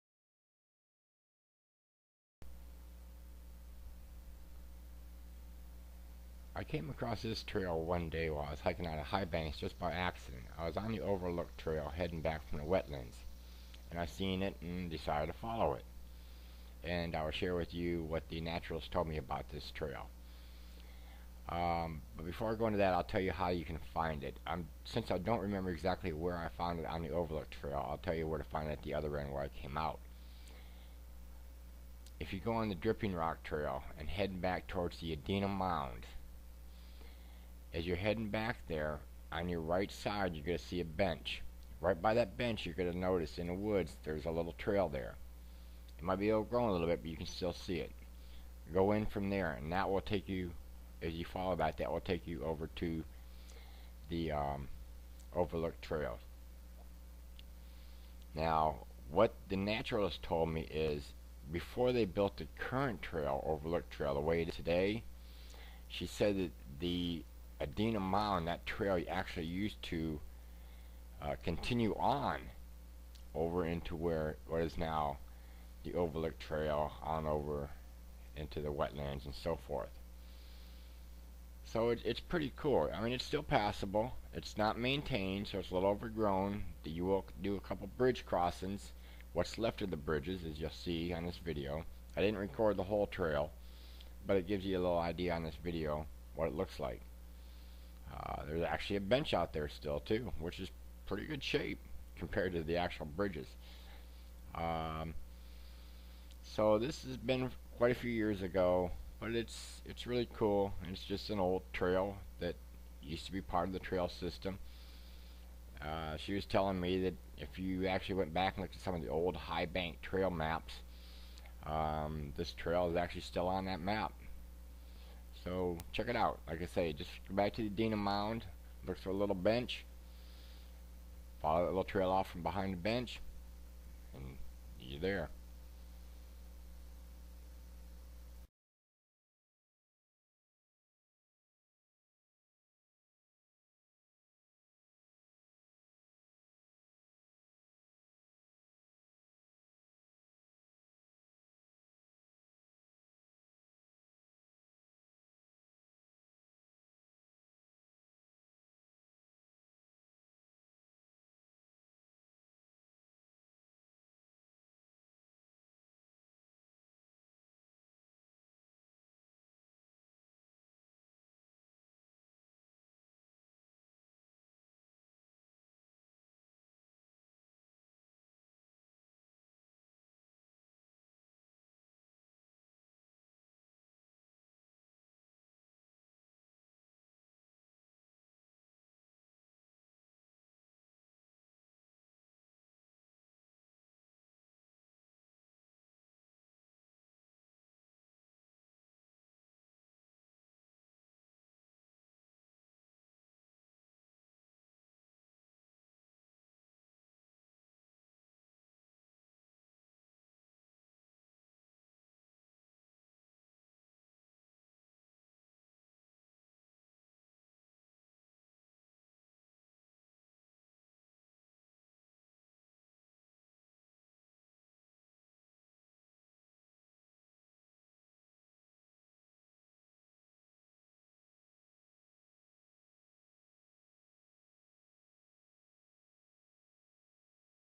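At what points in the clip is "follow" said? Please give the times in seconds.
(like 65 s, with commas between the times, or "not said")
15 s, 51 s, 131 s.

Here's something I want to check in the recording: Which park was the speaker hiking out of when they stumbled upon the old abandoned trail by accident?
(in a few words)
Highbanks.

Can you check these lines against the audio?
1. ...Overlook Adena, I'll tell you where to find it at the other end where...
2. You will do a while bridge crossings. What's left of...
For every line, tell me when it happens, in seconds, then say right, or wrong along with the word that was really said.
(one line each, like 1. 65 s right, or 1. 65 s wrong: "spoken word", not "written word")
1. 27 s wrong: "Trail", not "Adena"
2. 86 s wrong: "couple", not "while".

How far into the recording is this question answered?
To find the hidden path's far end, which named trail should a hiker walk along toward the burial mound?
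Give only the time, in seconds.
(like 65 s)
32 s.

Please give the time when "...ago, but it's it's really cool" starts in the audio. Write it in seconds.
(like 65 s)
108 s.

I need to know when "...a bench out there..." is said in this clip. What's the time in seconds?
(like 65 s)
98 s.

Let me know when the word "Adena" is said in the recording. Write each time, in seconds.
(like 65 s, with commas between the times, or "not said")
35 s, 67 s, 127 s.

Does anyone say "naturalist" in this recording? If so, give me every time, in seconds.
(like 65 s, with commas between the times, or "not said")
18 s, 59 s.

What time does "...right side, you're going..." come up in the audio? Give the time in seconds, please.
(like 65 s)
39 s.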